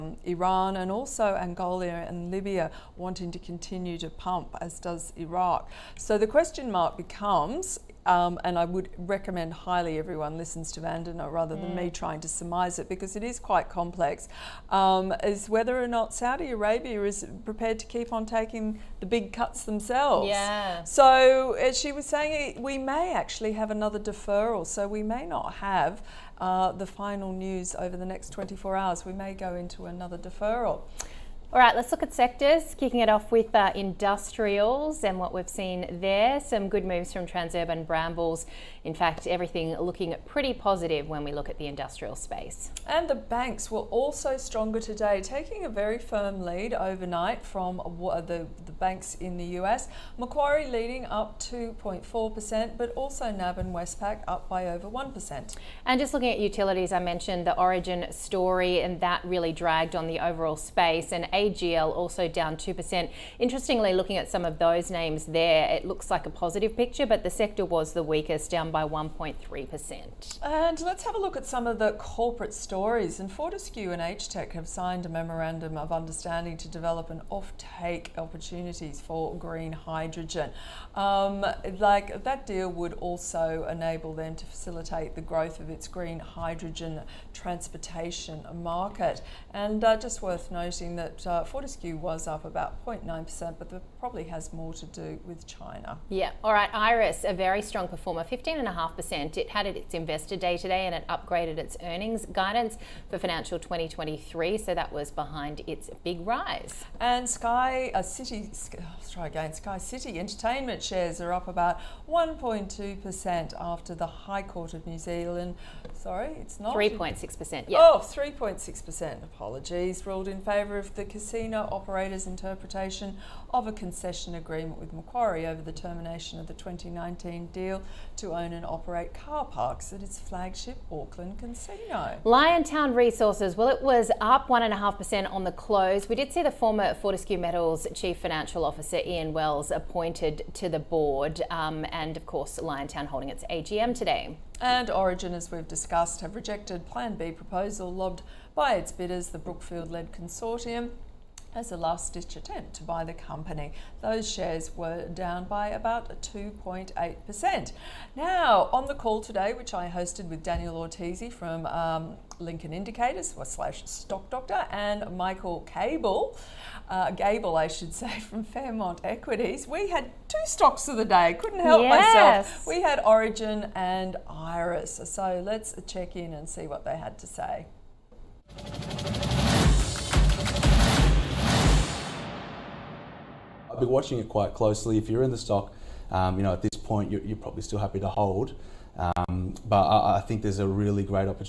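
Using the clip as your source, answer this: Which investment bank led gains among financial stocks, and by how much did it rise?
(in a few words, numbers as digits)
Macquarie, 2.4%.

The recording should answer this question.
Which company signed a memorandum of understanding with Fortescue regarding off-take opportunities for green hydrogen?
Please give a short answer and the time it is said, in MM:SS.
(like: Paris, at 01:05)
HTEC, at 01:14.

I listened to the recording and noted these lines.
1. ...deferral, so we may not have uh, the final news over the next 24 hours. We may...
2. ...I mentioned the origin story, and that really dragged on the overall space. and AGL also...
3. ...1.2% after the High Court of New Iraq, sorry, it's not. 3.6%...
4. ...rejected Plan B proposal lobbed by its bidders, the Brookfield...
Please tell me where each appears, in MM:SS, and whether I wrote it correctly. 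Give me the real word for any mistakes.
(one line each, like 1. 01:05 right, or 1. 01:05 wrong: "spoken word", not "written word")
1. 00:23 right
2. 00:56 right
3. 01:52 wrong: "Zealand", not "Iraq"
4. 02:26 right.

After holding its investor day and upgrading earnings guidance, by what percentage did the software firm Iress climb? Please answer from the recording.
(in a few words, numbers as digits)
15.5%.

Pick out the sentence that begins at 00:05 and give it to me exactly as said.
So the question mark becomes um, and I would recommend highly everyone listens to Vandana rather mm.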